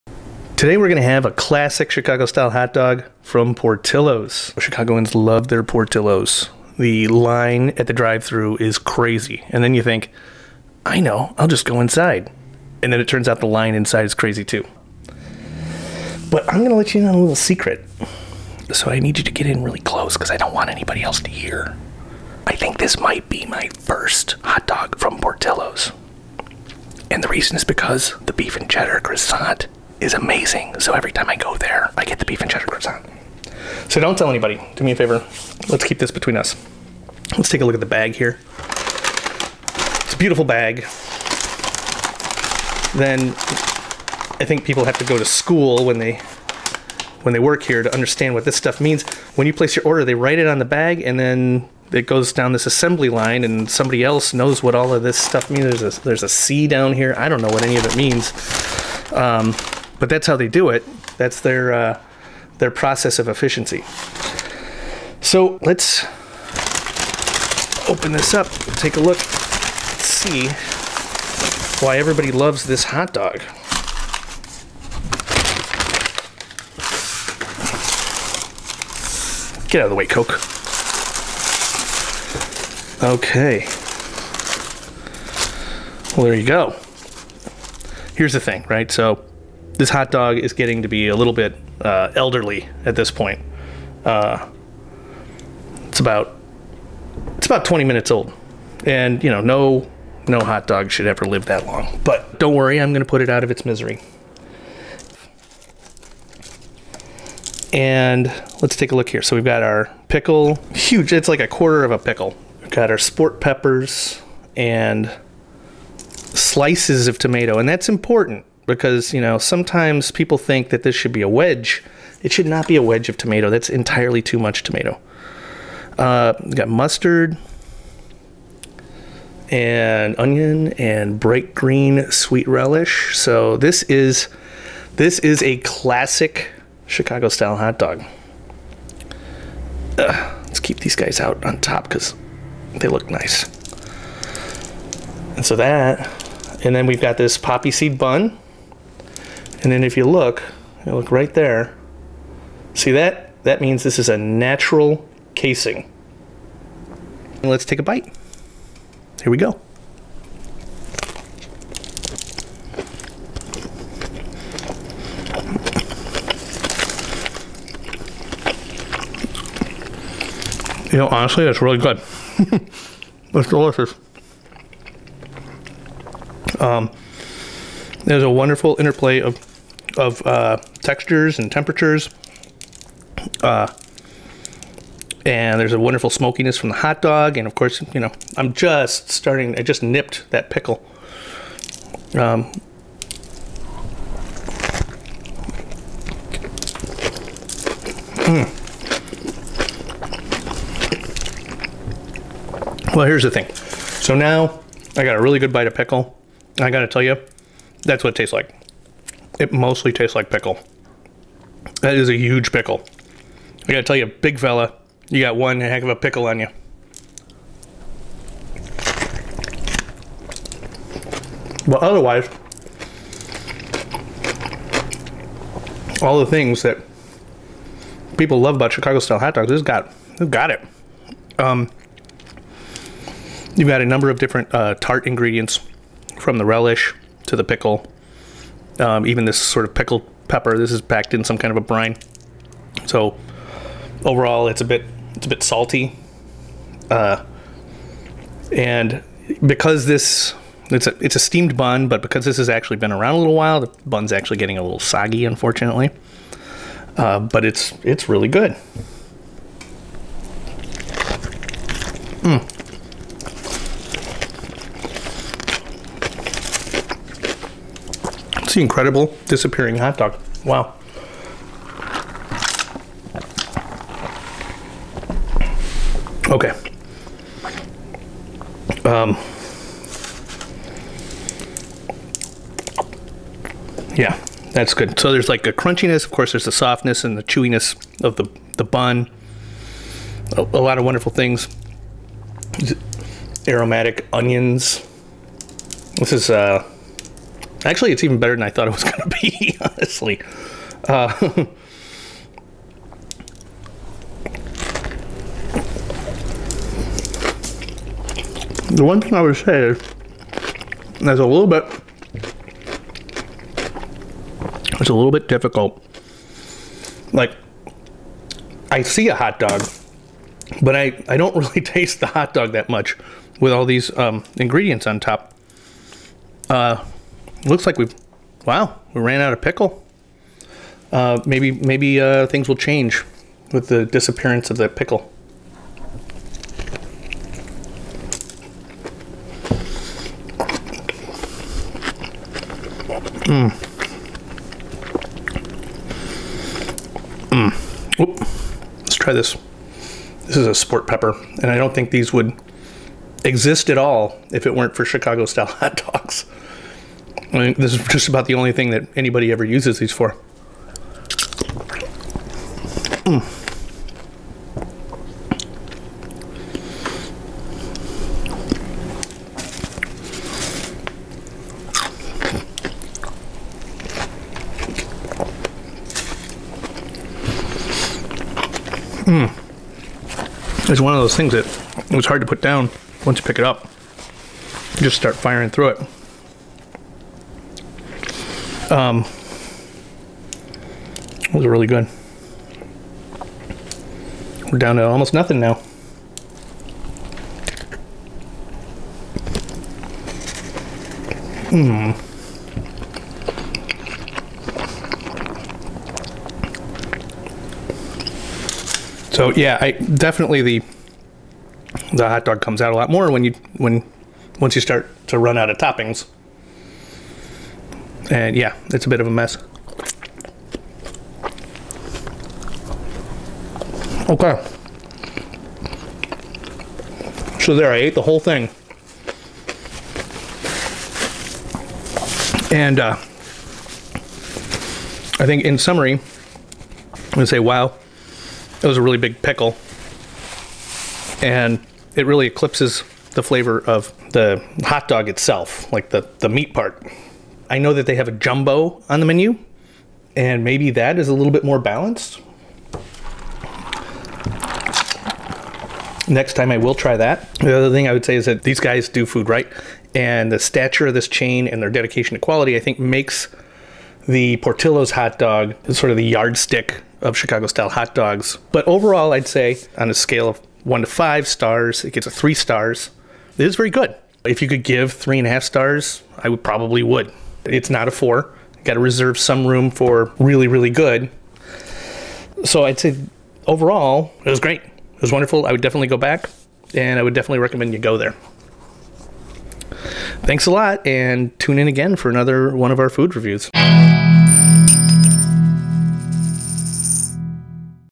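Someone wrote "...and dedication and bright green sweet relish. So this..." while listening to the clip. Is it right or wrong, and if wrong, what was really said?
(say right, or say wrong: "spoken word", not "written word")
wrong: "onion", not "dedication".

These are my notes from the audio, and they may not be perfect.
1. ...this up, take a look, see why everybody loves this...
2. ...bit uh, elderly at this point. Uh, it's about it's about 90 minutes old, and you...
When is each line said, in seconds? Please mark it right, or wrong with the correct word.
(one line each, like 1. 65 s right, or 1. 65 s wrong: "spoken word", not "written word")
1. 68 s right
2. 91 s wrong: "20", not "90".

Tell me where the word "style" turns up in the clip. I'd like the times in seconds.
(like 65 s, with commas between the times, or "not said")
2 s, 137 s, 228 s, 355 s, 467 s.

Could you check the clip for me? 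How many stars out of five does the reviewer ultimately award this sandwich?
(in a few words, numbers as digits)
3 stars.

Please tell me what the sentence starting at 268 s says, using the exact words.
It's the incredible disappearing hot dog.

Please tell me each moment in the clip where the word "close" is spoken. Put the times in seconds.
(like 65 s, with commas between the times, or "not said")
19 s.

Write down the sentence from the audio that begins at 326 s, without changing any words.
Uh, looks like we've, wow, we ran out of pickle.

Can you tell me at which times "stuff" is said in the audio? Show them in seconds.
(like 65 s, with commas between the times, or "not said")
48 s, 55 s.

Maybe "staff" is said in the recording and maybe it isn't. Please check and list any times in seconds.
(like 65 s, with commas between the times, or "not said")
not said.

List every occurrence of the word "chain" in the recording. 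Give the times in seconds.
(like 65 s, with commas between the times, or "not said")
461 s.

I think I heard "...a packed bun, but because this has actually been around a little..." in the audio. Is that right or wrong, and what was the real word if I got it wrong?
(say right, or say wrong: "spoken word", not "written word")
wrong: "steamed", not "packed".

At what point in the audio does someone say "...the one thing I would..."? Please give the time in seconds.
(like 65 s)
308 s.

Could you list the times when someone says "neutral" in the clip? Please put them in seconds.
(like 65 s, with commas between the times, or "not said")
not said.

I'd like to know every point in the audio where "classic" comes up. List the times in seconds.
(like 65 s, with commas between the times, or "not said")
1 s, 135 s.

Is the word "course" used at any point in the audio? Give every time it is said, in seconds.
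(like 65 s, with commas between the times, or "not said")
187 s, 286 s.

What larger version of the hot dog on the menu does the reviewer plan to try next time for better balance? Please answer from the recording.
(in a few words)
A jumbo.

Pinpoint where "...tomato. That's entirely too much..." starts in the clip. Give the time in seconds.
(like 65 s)
123 s.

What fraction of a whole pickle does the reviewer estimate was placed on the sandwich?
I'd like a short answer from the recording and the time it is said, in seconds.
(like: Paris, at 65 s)
A quarter, at 111 s.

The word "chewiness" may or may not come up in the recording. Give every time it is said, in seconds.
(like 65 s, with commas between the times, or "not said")
287 s.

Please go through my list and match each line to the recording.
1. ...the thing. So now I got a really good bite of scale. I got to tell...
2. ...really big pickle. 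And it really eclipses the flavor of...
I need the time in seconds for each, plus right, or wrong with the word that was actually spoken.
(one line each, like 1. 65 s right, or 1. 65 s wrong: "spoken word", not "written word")
1. 203 s wrong: "pickle", not "scale"
2. 438 s right.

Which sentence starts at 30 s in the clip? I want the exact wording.
So every time I go there, I get the beef and cheddar croissant.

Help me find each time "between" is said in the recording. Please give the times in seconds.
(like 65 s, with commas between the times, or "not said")
36 s.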